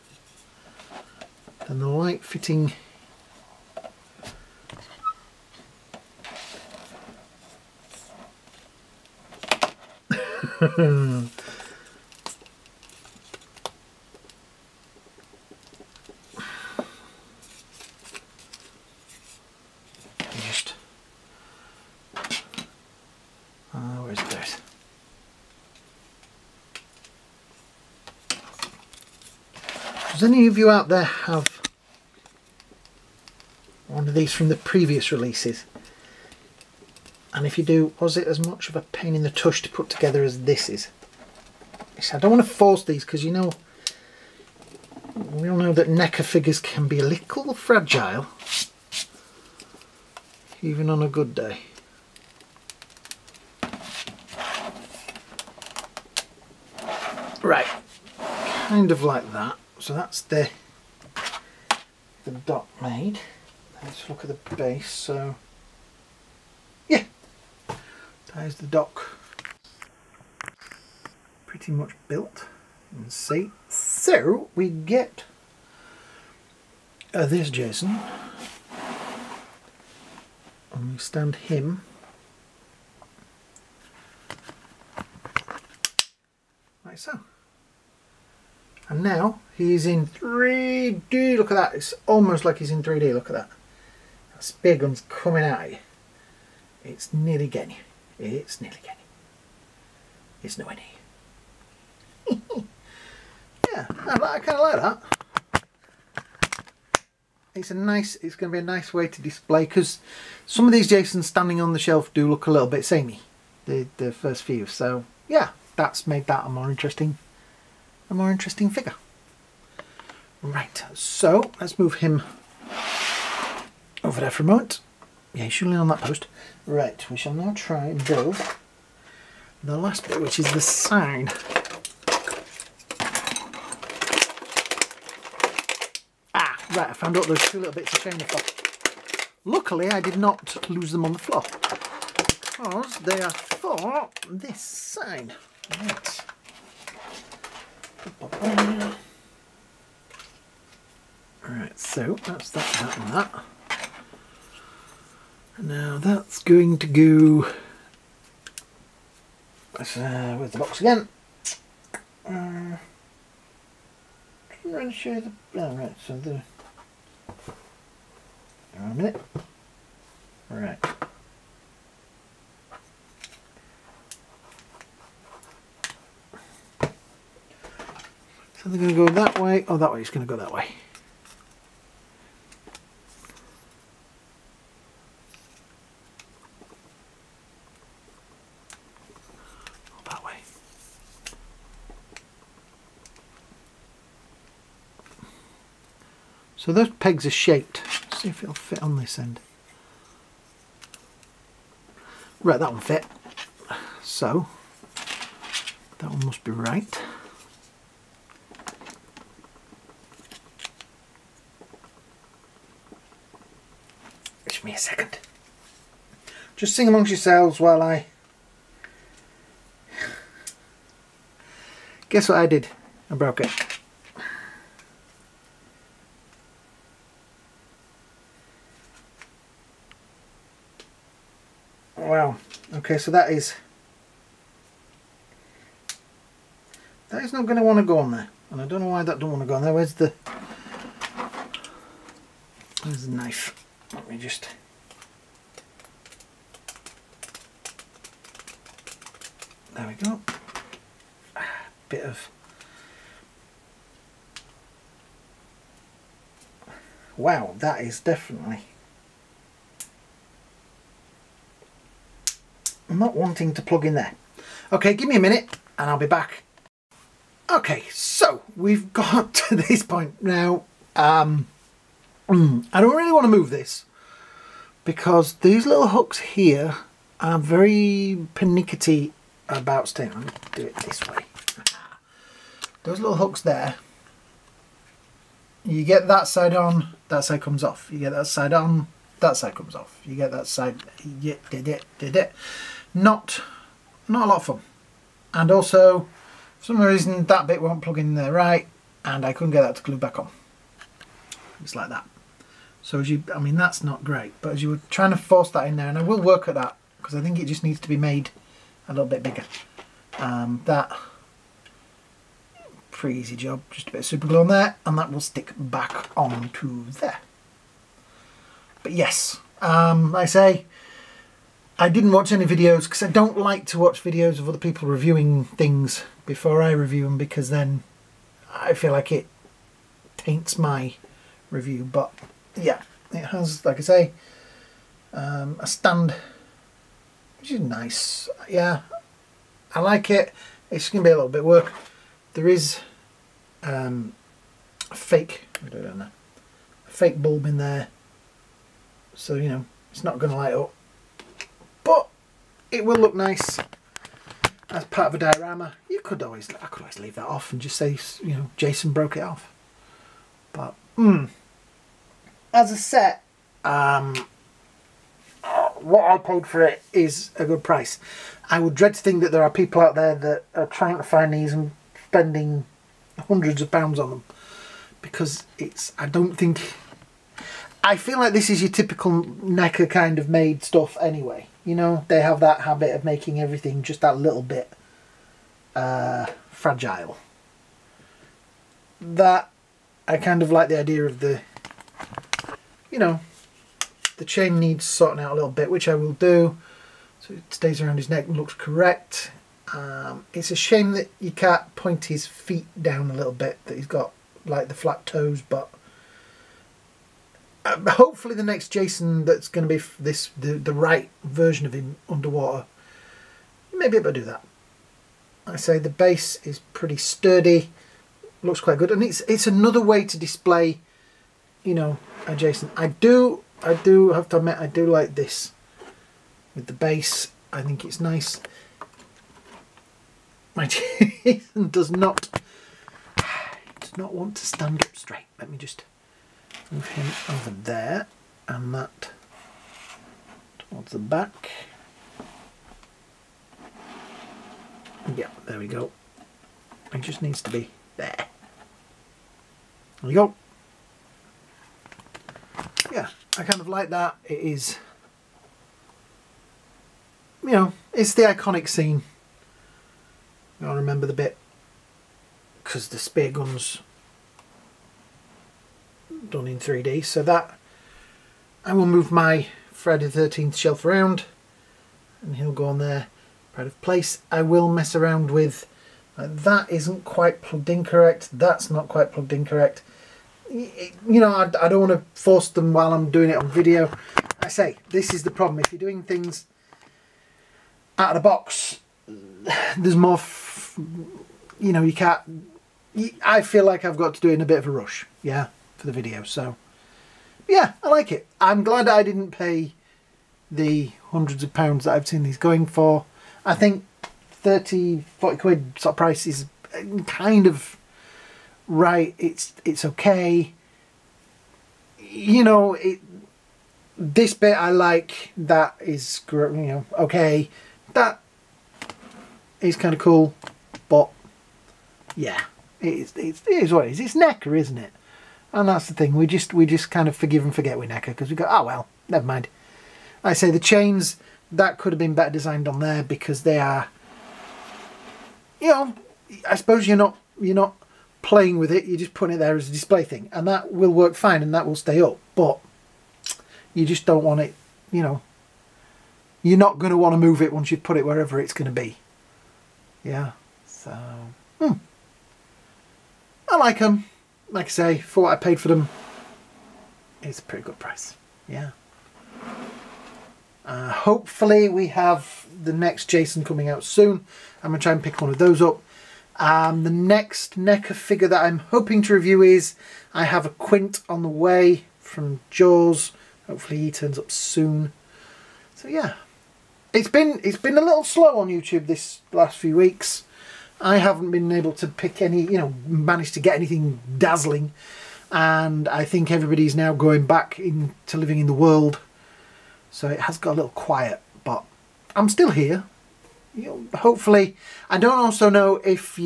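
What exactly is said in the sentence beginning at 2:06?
Right, we shall now try and build the last bit, which is the sign.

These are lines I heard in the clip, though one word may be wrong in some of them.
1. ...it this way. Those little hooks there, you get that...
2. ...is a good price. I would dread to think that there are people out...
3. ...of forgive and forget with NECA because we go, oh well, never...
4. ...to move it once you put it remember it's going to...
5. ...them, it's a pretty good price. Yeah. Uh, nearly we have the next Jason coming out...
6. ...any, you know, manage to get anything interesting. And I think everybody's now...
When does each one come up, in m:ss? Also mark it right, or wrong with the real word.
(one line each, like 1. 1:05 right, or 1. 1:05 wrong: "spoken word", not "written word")
1. 4:40 right
2. 6:06 right
3. 8:47 right
4. 9:07 wrong: "wherever", not "remember"
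5. 9:15 wrong: "hopefully", not "nearly"
6. 9:42 wrong: "dazzling", not "interesting".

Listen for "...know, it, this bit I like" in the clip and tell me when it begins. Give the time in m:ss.
8:32.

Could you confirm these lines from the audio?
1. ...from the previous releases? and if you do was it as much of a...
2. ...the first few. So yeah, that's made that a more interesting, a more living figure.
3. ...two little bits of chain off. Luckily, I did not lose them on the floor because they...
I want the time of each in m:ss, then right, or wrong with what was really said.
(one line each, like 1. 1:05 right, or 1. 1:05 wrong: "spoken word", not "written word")
1. 0:34 right
2. 1:53 wrong: "interesting", not "living"
3. 2:17 right.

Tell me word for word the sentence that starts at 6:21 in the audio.
You know, they have that habit of making everything just that little bit uh, fragile.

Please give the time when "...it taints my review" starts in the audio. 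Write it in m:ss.
5:29.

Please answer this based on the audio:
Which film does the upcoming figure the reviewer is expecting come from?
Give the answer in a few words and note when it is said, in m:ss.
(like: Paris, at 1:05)
Jaws, at 9:32.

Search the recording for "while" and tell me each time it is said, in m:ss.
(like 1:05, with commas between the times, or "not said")
3:37, 8:02.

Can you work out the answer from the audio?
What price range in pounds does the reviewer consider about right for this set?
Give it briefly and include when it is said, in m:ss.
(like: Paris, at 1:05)
30 to 40 pounds, at 8:24.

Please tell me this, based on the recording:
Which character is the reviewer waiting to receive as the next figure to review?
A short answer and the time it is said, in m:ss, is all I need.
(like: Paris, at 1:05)
Quint, at 9:30.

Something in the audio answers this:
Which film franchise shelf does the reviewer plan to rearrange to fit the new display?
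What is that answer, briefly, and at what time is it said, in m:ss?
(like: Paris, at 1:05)
Friday the 13th, at 7:49.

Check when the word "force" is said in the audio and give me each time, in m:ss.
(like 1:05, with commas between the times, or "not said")
0:42, 5:05, 8:02.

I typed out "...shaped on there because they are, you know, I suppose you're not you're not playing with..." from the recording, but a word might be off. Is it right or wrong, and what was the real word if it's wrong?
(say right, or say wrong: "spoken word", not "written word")
wrong: "designed", not "shaped".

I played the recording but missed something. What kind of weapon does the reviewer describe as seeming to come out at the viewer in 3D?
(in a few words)
Spear gun.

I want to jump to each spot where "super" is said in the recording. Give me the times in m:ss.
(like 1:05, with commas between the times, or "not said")
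5:14.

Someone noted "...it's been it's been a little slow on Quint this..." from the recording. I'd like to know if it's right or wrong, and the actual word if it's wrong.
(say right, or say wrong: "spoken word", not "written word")
wrong: "YouTube", not "Quint".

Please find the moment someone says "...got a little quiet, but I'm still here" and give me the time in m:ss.
9:50.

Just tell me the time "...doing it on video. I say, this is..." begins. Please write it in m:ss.
8:03.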